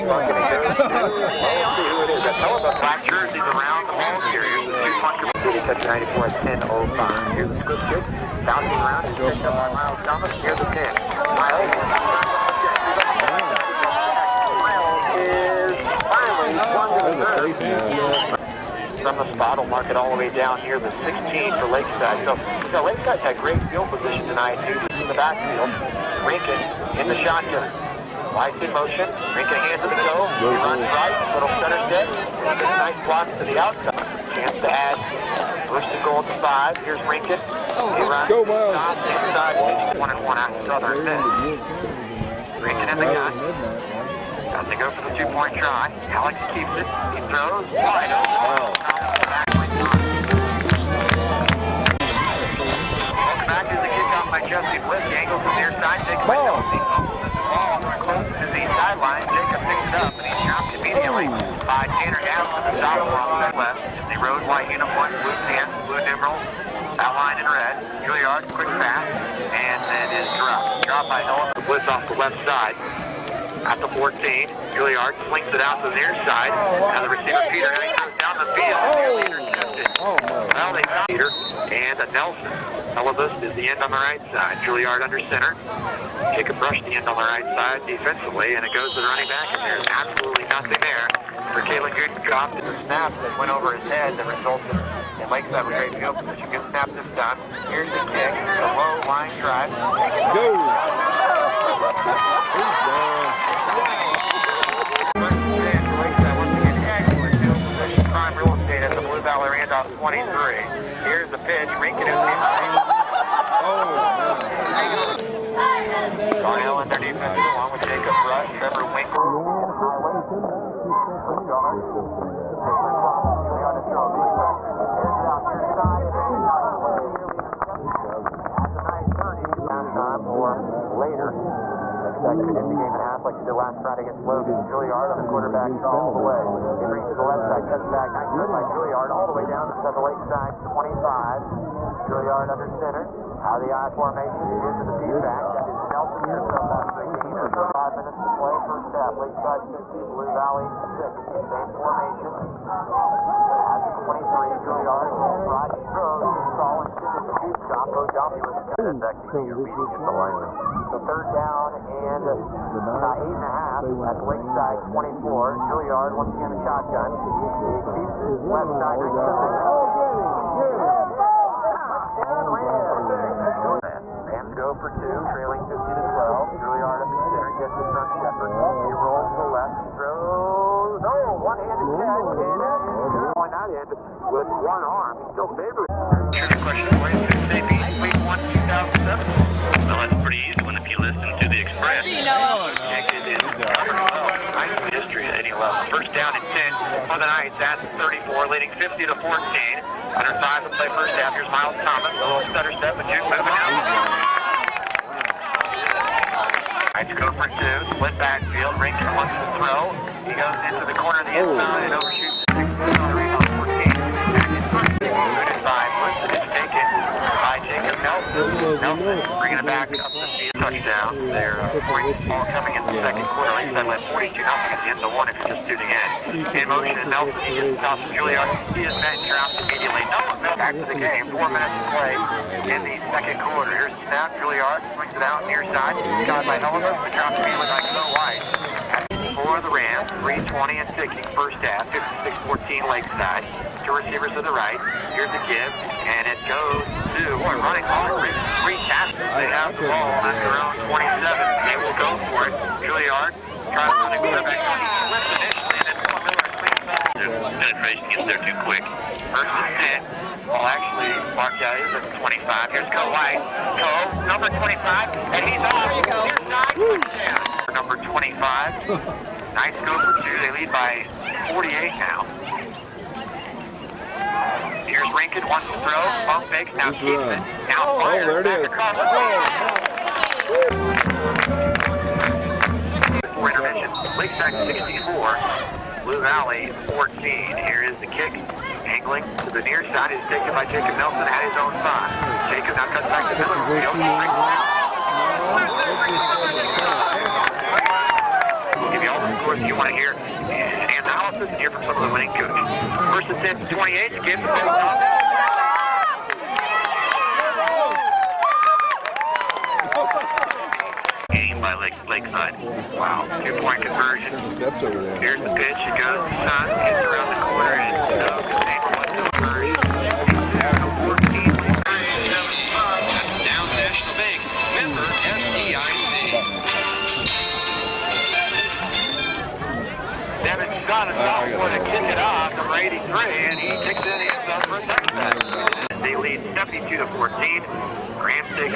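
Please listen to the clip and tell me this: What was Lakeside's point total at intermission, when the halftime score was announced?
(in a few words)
64.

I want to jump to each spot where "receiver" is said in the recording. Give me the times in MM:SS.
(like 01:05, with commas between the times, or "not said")
01:17, 04:03.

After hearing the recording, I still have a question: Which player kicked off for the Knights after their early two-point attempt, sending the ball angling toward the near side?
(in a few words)
Jesse Bliss.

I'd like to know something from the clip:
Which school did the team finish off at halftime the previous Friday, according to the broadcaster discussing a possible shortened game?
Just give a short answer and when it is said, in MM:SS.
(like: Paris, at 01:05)
Logan, at 02:14.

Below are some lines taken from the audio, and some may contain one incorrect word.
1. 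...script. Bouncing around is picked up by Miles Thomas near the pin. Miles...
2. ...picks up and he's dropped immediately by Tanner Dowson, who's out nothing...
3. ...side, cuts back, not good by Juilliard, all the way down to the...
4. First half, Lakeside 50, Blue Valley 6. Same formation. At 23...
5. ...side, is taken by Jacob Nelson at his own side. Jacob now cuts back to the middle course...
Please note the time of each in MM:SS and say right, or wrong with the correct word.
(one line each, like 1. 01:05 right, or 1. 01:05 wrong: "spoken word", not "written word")
1. 00:07 right
2. 00:59 wrong: "along", not "nothing"
3. 02:17 right
4. 02:28 right
5. 04:49 right.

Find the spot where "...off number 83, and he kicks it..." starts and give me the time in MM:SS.
05:32.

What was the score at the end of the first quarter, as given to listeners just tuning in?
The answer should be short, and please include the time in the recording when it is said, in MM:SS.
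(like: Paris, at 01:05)
42-0, at 03:44.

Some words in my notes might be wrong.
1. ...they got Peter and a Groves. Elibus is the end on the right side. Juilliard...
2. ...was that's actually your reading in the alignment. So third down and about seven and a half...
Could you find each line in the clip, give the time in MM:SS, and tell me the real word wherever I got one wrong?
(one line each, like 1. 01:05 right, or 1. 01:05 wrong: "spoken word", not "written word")
1. 01:20 wrong: "Nelson", not "Groves"
2. 02:38 wrong: "eight", not "seven".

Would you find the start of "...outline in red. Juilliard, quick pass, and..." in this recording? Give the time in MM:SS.
01:06.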